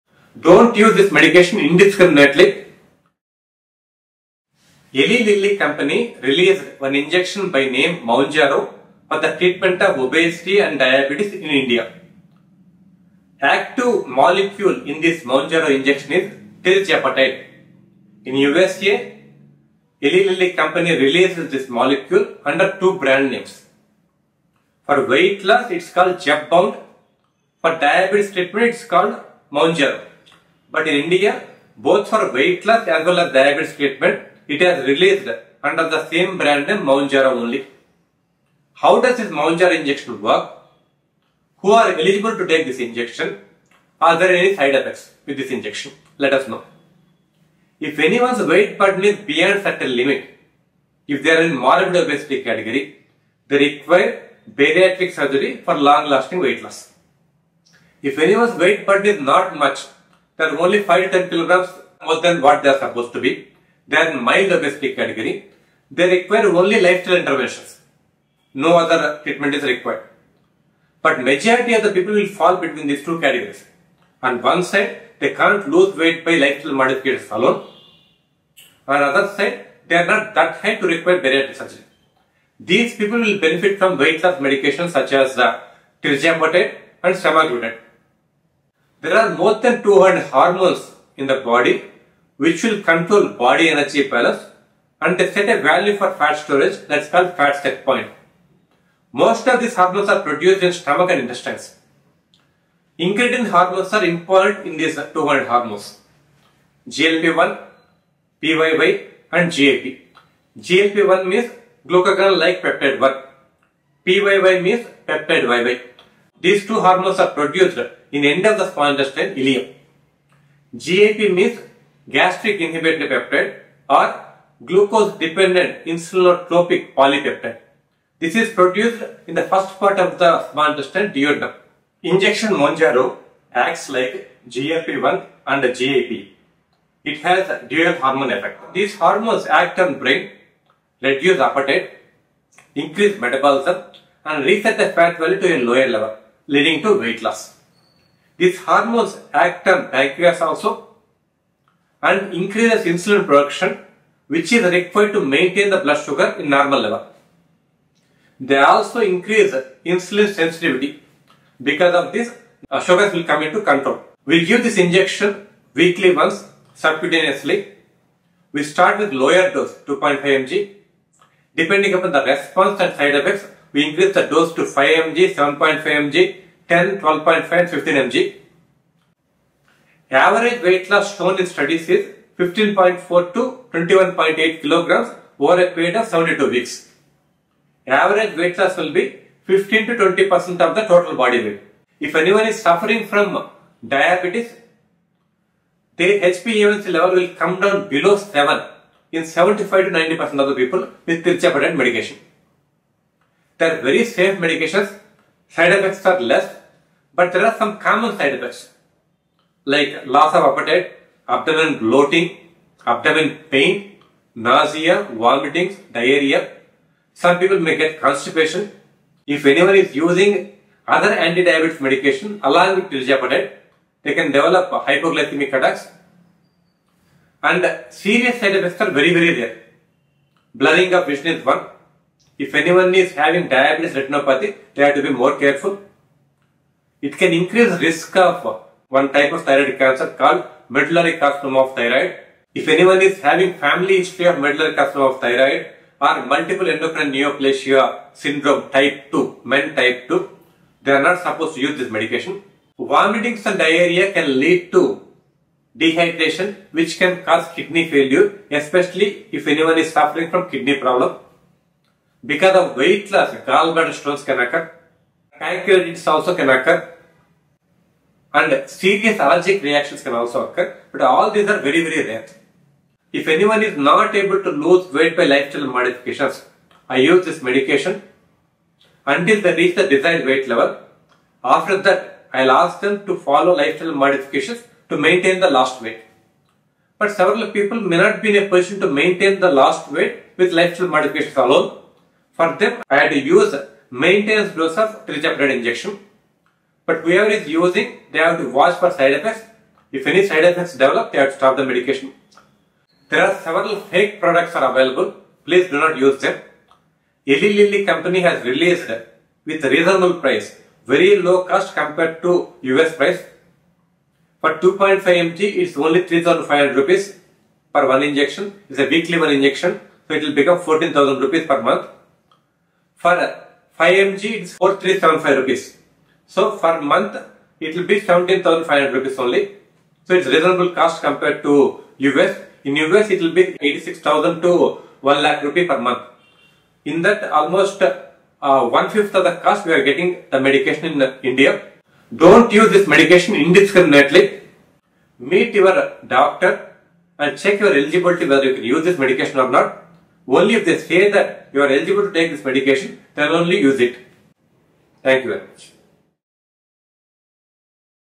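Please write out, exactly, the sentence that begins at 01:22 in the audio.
These people will benefit from weight loss medications such as uh, and semaglutide.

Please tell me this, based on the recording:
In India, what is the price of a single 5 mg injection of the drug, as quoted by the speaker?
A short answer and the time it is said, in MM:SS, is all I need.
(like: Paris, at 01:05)
4,375 rupees, at 05:24.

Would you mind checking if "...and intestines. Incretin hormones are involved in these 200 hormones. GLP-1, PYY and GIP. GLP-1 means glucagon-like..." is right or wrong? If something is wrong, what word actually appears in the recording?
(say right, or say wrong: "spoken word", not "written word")
right.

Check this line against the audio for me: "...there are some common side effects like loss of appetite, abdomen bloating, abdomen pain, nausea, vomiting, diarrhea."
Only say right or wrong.
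right.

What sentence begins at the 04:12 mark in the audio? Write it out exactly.
Vomitings and diarrhea can lead to dehydration which can cause kidney failure especially if anyone is suffering from kidney problem.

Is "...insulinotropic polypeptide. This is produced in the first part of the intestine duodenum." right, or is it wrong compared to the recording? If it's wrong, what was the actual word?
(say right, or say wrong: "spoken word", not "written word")
right.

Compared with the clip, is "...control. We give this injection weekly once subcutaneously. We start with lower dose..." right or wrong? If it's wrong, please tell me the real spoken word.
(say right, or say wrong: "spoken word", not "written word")
right.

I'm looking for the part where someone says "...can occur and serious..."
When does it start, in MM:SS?
04:26.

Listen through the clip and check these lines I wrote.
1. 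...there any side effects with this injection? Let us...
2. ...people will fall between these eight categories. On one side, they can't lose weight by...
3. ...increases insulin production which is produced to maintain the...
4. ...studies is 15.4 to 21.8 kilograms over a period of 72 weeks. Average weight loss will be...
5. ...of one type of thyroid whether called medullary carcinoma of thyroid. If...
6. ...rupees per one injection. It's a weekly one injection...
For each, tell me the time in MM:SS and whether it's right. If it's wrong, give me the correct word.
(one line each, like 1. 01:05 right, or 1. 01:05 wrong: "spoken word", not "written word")
1. 00:44 right
2. 01:11 wrong: "two", not "eight"
3. 02:32 wrong: "required", not "produced"
4. 03:01 right
5. 03:58 wrong: "cancer", not "whether"
6. 05:16 right.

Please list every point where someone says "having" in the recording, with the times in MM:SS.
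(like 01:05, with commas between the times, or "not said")
03:53, 04:03.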